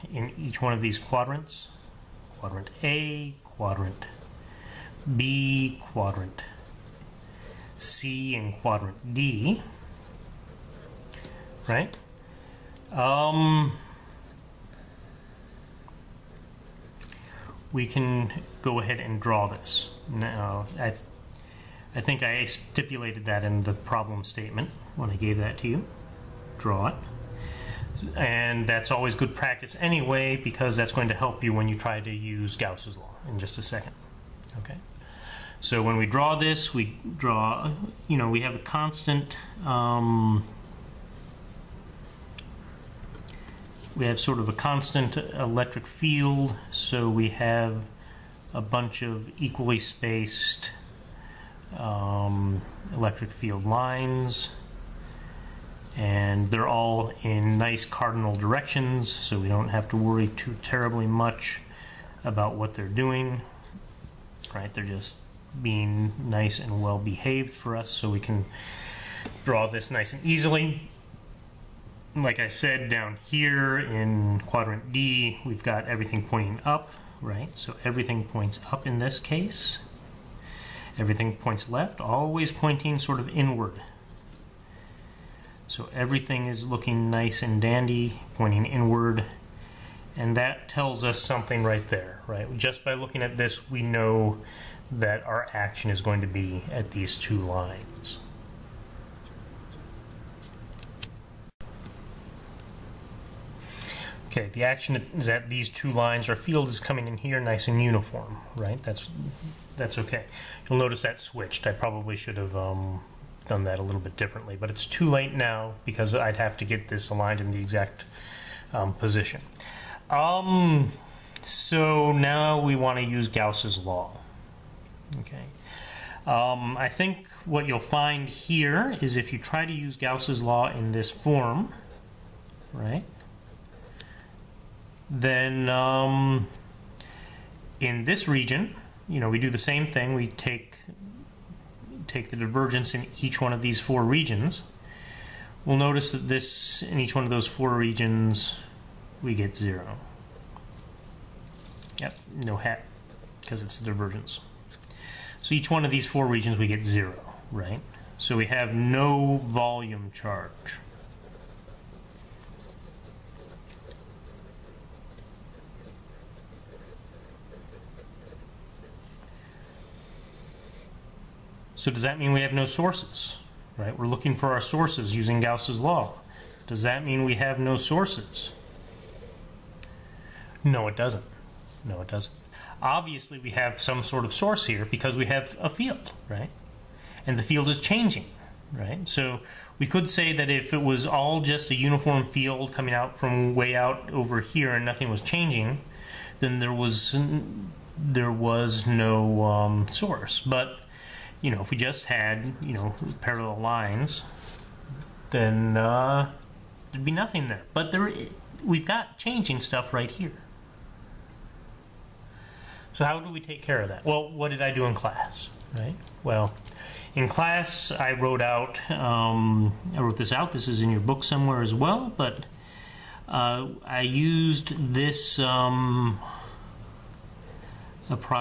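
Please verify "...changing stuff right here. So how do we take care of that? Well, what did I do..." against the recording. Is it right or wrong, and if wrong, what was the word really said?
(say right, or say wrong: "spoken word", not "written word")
right.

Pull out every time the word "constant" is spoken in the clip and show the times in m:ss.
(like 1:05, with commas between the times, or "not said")
0:38, 0:44.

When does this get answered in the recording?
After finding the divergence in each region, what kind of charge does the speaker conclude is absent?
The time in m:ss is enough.
2:39.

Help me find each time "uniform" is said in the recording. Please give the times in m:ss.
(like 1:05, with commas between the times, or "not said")
1:47, 3:11.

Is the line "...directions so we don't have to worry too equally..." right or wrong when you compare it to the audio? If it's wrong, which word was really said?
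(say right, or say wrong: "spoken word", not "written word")
wrong: "terribly", not "equally".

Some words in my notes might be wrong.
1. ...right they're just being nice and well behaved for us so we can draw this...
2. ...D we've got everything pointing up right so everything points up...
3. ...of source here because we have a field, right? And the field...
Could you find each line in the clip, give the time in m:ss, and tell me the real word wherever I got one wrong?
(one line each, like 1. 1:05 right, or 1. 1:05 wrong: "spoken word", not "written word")
1. 1:04 right
2. 1:14 right
3. 3:04 right.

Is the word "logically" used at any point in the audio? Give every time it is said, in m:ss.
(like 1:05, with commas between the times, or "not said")
not said.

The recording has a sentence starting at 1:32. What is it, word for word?
Just by looking at this, we know that our action is going to be at these two lines.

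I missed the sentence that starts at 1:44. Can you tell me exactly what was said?
Okay, the action is at these two lines.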